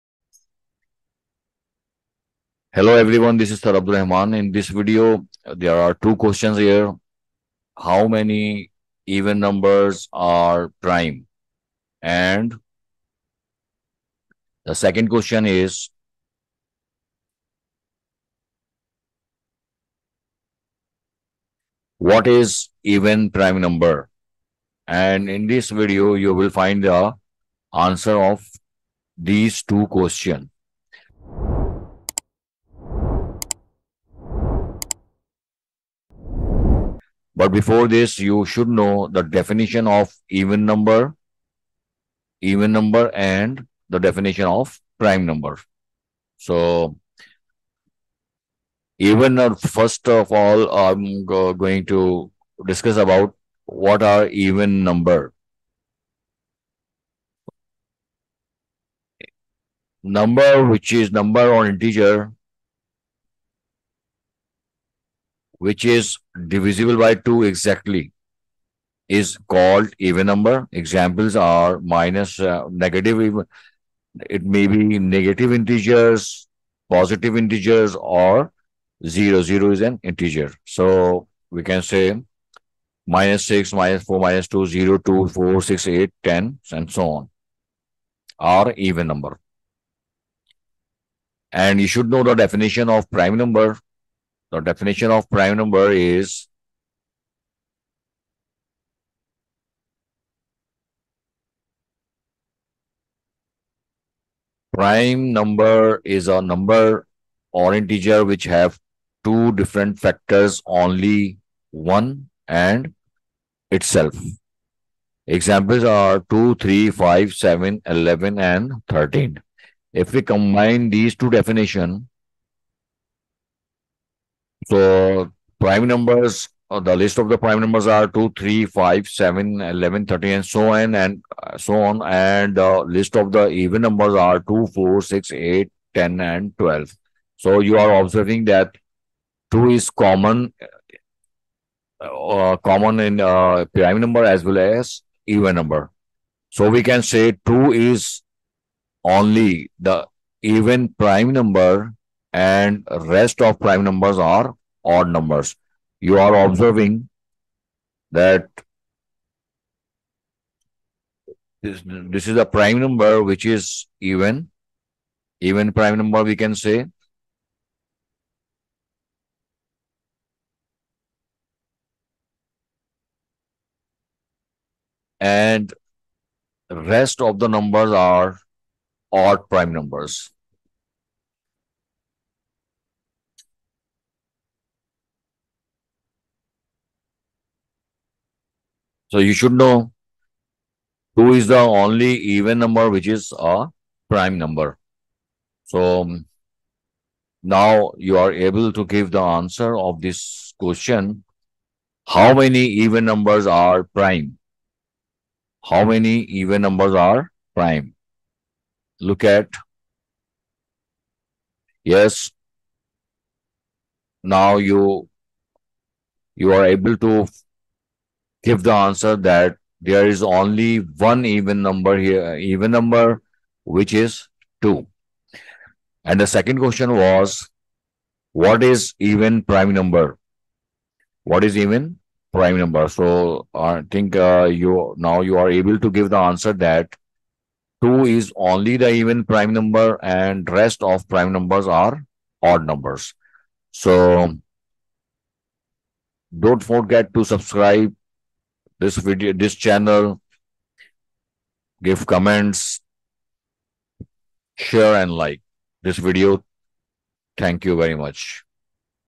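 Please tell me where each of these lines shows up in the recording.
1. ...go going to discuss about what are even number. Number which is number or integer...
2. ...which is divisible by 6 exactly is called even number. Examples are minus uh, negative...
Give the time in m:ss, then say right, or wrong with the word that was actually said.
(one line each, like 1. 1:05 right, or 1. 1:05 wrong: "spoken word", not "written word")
1. 0:51 right
2. 1:05 wrong: "2", not "6".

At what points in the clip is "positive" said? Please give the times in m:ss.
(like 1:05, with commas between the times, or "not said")
1:16.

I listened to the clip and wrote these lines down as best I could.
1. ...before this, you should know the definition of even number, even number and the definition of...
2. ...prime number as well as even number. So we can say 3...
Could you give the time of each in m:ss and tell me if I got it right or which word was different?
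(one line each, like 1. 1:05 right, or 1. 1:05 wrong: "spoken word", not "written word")
1. 0:37 right
2. 2:23 wrong: "2", not "3".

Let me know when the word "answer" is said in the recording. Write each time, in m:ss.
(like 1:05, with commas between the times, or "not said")
0:27, 3:19, 3:38, 3:56.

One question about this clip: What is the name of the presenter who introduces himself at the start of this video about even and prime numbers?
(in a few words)
Abdur Rehman.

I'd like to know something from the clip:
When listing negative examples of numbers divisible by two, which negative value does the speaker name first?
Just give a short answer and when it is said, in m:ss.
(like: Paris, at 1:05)
-6, at 1:23.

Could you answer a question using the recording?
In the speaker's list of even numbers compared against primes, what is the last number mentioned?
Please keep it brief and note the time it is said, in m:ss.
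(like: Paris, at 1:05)
12, at 2:16.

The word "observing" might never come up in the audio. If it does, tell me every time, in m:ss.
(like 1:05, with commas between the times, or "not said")
2:17, 2:36.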